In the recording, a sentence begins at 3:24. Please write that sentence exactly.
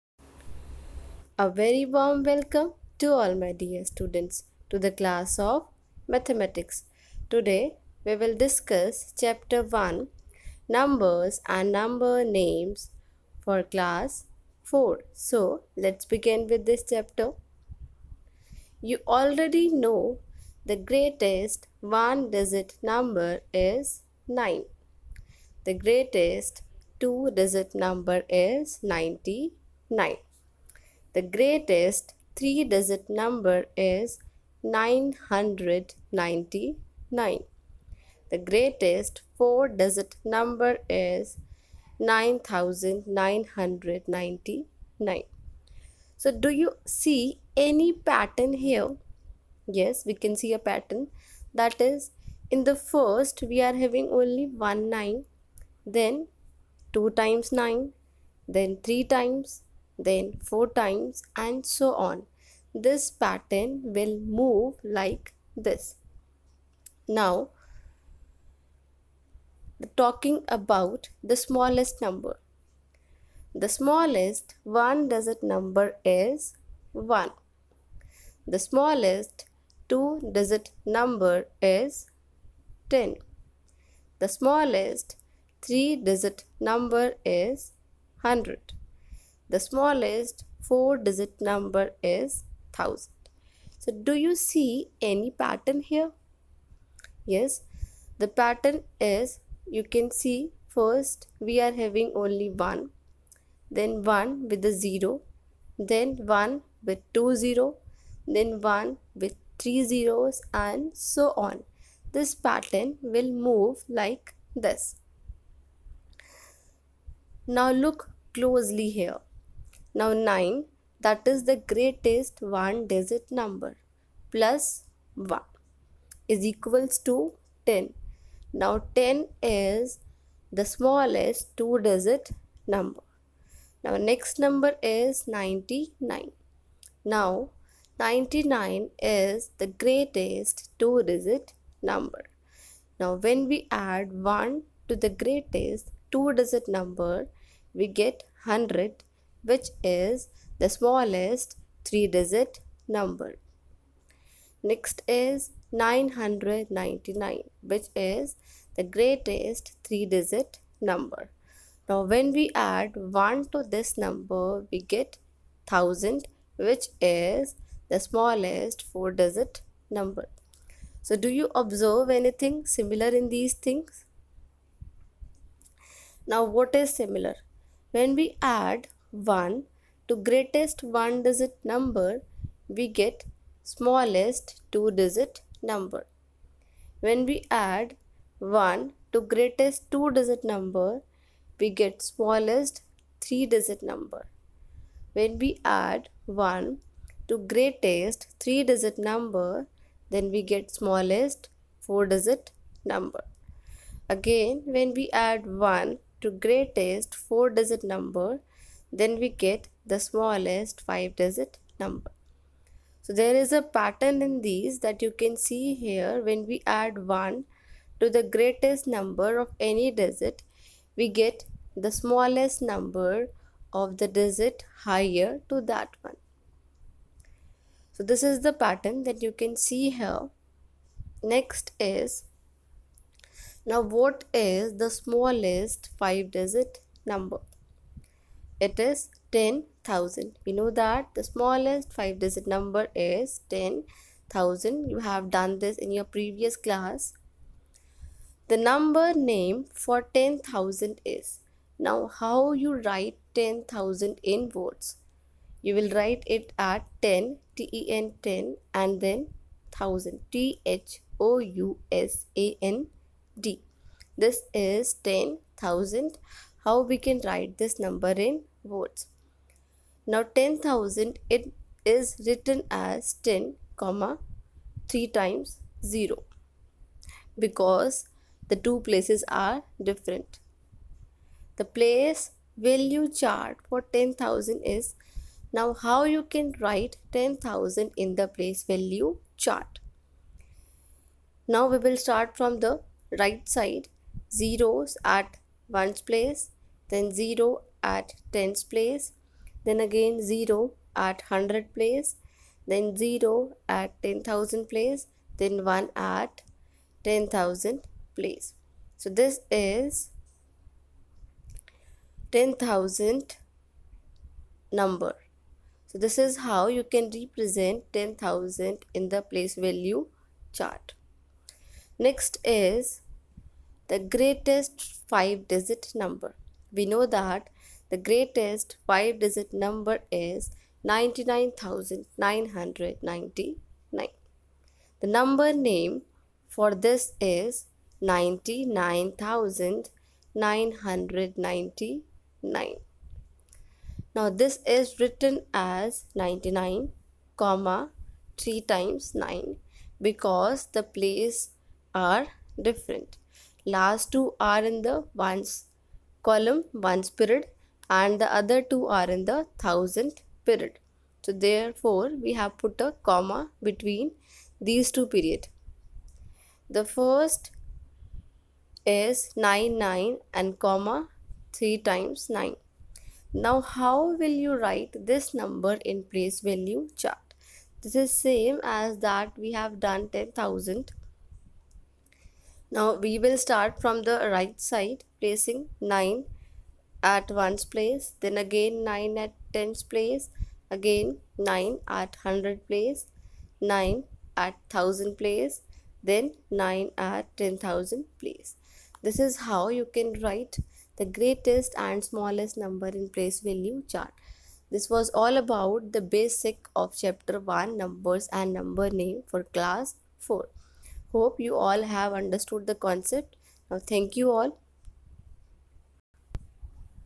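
Again when we add 1 to greatest four digit number then we get the smallest 5 digit number.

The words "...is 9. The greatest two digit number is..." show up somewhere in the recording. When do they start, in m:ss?
0:23.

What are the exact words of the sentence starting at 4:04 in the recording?
You have done this in your previous class.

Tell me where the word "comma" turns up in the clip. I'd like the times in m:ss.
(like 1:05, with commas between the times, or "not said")
4:33, 5:47, 6:03, 6:10.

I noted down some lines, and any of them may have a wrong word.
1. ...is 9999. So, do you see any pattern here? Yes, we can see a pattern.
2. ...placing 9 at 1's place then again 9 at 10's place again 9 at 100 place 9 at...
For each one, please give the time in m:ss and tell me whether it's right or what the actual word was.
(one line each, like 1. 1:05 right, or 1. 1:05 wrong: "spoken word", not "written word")
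1. 0:40 right
2. 6:25 right.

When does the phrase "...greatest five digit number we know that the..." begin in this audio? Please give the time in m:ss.
5:23.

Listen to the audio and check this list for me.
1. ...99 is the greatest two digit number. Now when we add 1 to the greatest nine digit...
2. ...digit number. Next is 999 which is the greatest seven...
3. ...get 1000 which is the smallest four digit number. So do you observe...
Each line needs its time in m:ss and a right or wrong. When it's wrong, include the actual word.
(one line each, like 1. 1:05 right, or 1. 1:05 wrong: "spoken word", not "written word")
1. 2:17 wrong: "two", not "nine"
2. 2:32 wrong: "three", not "seven"
3. 2:44 right.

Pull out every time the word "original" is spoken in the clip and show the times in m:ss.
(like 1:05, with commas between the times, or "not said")
not said.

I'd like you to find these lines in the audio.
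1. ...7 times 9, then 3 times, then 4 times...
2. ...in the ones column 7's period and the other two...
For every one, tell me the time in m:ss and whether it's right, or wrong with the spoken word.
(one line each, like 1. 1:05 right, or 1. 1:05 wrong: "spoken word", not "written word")
1. 0:56 wrong: "2", not "7"
2. 5:54 wrong: "1", not "7".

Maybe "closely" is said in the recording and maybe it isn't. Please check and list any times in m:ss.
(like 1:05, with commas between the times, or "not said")
1:58.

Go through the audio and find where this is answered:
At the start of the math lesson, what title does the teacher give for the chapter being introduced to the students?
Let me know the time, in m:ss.
0:10.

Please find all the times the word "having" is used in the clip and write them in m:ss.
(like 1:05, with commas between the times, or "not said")
0:53, 1:41.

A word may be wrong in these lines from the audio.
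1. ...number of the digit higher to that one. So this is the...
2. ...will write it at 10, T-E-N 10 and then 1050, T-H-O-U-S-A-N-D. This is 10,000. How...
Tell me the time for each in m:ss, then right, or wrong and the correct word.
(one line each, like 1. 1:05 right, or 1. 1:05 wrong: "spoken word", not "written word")
1. 3:42 right
2. 4:15 wrong: "1000", not "1050".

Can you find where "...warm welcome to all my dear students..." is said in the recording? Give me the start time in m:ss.
0:01.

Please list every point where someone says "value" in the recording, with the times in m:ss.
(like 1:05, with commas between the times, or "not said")
4:42, 4:48, 5:19, 6:16, 6:43.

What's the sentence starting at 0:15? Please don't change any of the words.
So let's begin with this chapter.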